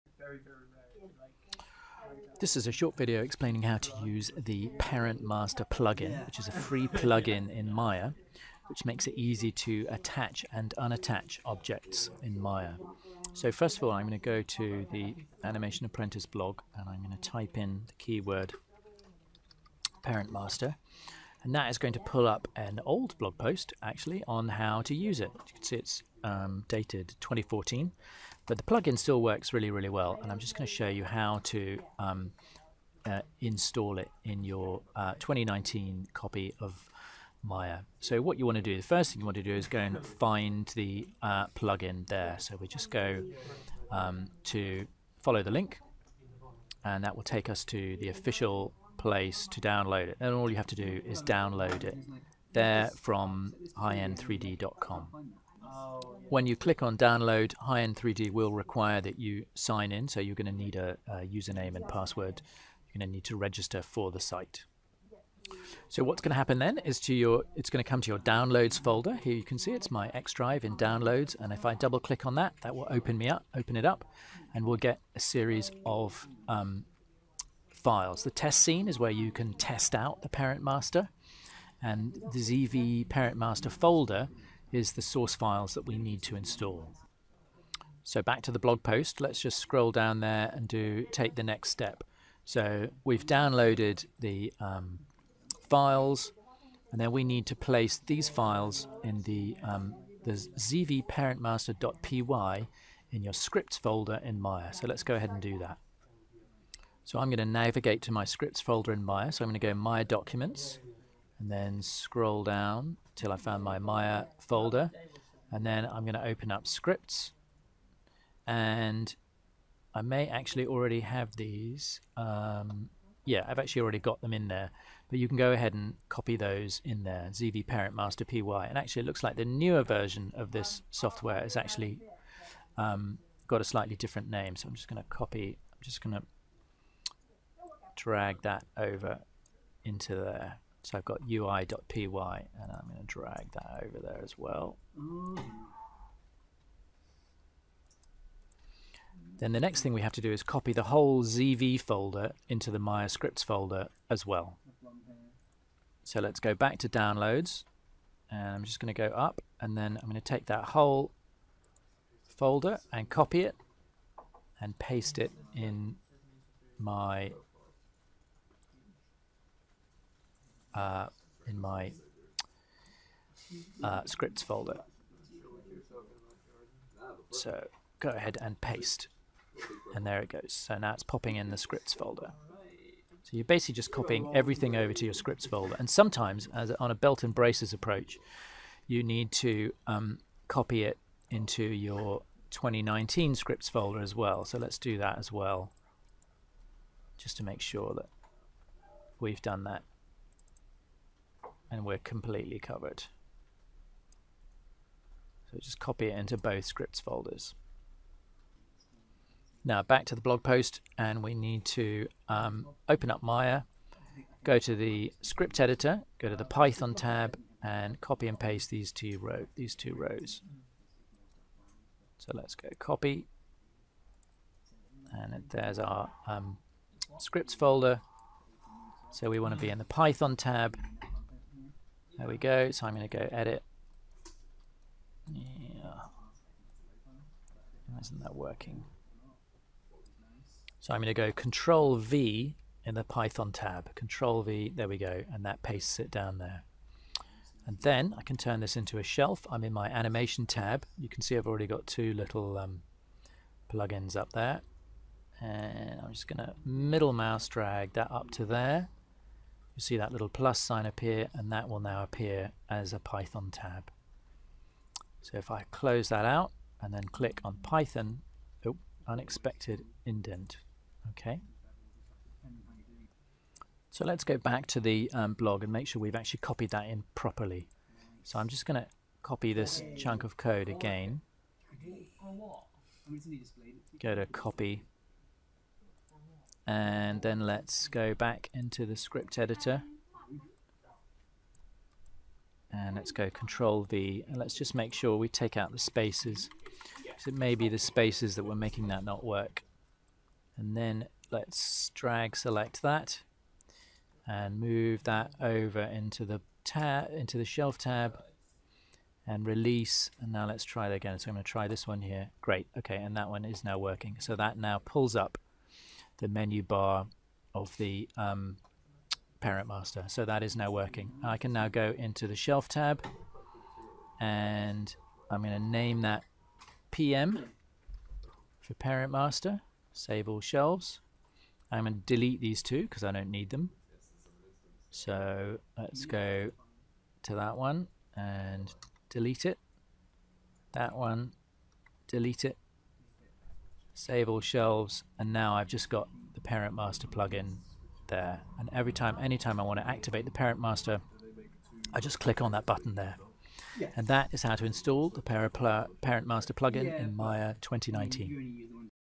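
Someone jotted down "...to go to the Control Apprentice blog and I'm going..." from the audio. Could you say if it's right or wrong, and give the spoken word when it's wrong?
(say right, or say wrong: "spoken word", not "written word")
wrong: "Animation", not "Control".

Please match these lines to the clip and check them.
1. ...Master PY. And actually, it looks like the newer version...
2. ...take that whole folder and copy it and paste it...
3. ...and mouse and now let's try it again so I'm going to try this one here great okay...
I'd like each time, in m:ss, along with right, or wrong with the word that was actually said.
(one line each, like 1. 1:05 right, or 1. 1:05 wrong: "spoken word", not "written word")
1. 2:07 right
2. 2:40 right
3. 5:09 wrong: "release", not "mouse".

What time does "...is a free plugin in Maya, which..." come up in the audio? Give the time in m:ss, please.
0:06.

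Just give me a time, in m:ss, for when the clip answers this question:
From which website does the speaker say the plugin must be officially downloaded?
0:53.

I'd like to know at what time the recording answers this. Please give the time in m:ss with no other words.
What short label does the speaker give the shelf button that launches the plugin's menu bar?
5:26.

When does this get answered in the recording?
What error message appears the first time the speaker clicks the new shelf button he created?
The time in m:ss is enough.
4:29.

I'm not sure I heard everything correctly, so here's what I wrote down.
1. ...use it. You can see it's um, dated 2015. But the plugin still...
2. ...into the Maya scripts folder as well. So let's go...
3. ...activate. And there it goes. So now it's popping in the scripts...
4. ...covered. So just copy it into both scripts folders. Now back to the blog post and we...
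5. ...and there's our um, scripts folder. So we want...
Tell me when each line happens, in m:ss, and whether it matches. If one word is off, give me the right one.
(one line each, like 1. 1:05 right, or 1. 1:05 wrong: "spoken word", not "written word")
1. 0:24 wrong: "2014", not "2015"
2. 2:32 right
3. 2:58 wrong: "paste", not "activate"
4. 3:22 right
5. 3:45 right.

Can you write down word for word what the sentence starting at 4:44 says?
Go to copy and then let's go back into the script editor.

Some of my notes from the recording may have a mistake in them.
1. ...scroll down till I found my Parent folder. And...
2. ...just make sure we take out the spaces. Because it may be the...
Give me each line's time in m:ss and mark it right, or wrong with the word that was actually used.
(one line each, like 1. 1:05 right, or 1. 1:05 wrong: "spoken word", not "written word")
1. 1:51 wrong: "Maya", not "Parent"
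2. 4:54 right.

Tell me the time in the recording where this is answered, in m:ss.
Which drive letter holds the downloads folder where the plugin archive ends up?
1:10.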